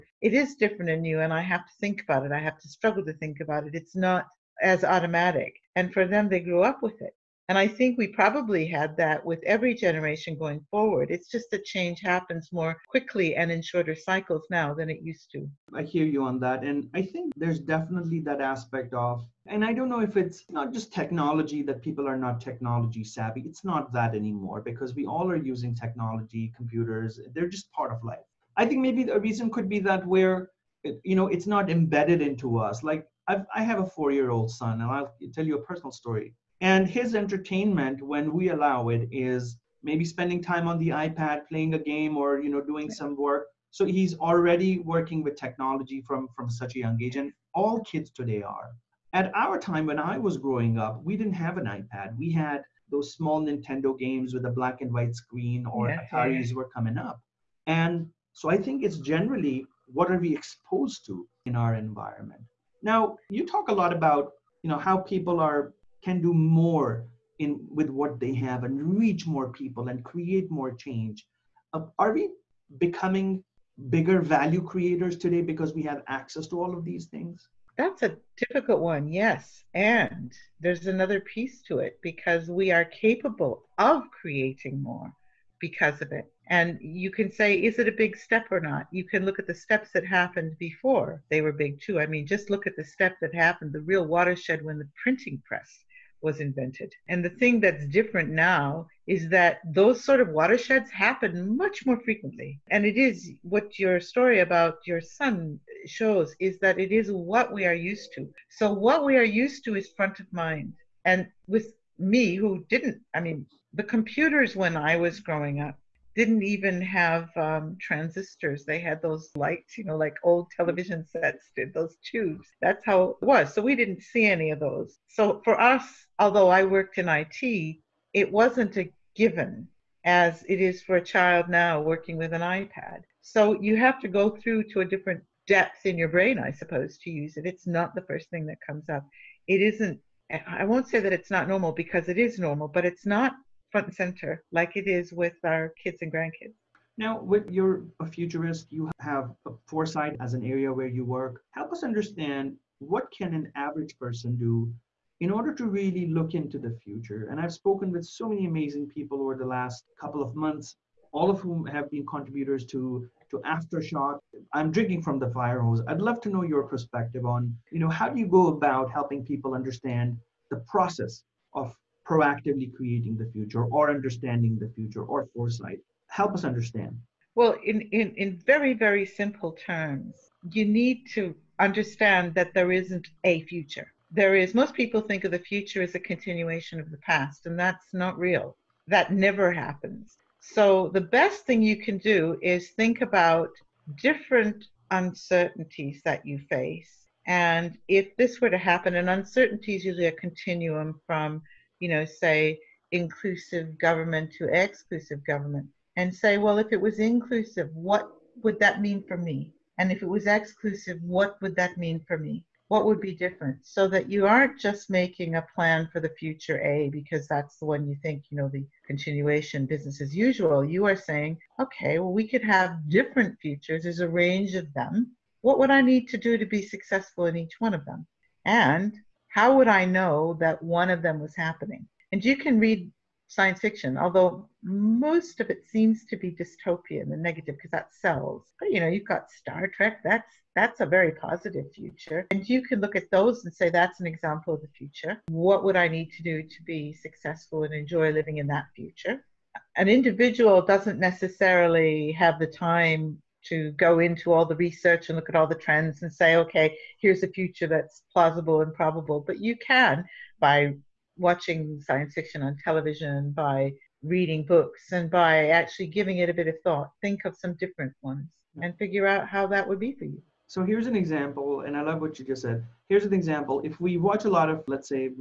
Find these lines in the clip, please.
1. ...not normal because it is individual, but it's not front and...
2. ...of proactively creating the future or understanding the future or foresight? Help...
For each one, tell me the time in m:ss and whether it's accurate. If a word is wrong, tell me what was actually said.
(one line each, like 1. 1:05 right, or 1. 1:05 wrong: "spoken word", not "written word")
1. 2:21 wrong: "normal", not "individual"
2. 2:51 right.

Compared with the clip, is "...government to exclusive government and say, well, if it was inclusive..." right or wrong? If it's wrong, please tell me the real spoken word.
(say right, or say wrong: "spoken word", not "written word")
right.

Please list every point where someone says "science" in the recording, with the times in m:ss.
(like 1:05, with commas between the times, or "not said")
3:53, 4:21.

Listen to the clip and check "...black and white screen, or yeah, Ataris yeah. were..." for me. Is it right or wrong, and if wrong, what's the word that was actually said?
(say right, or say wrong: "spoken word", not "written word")
right.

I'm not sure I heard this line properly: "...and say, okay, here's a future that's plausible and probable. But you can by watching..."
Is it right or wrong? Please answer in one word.
right.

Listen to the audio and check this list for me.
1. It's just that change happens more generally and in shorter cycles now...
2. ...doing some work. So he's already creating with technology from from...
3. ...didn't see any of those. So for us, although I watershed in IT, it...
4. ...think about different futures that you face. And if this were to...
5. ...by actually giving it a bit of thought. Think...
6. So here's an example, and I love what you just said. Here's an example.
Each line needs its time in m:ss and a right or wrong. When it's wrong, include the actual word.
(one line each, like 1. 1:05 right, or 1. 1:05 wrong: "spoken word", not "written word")
1. 0:11 wrong: "quickly", not "generally"
2. 0:42 wrong: "working", not "creating"
3. 2:03 wrong: "worked", not "watershed"
4. 3:12 wrong: "uncertainties", not "futures"
5. 4:25 right
6. 4:30 right.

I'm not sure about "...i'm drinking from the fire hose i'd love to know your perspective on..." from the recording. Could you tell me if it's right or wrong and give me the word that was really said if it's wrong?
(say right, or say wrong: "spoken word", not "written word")
right.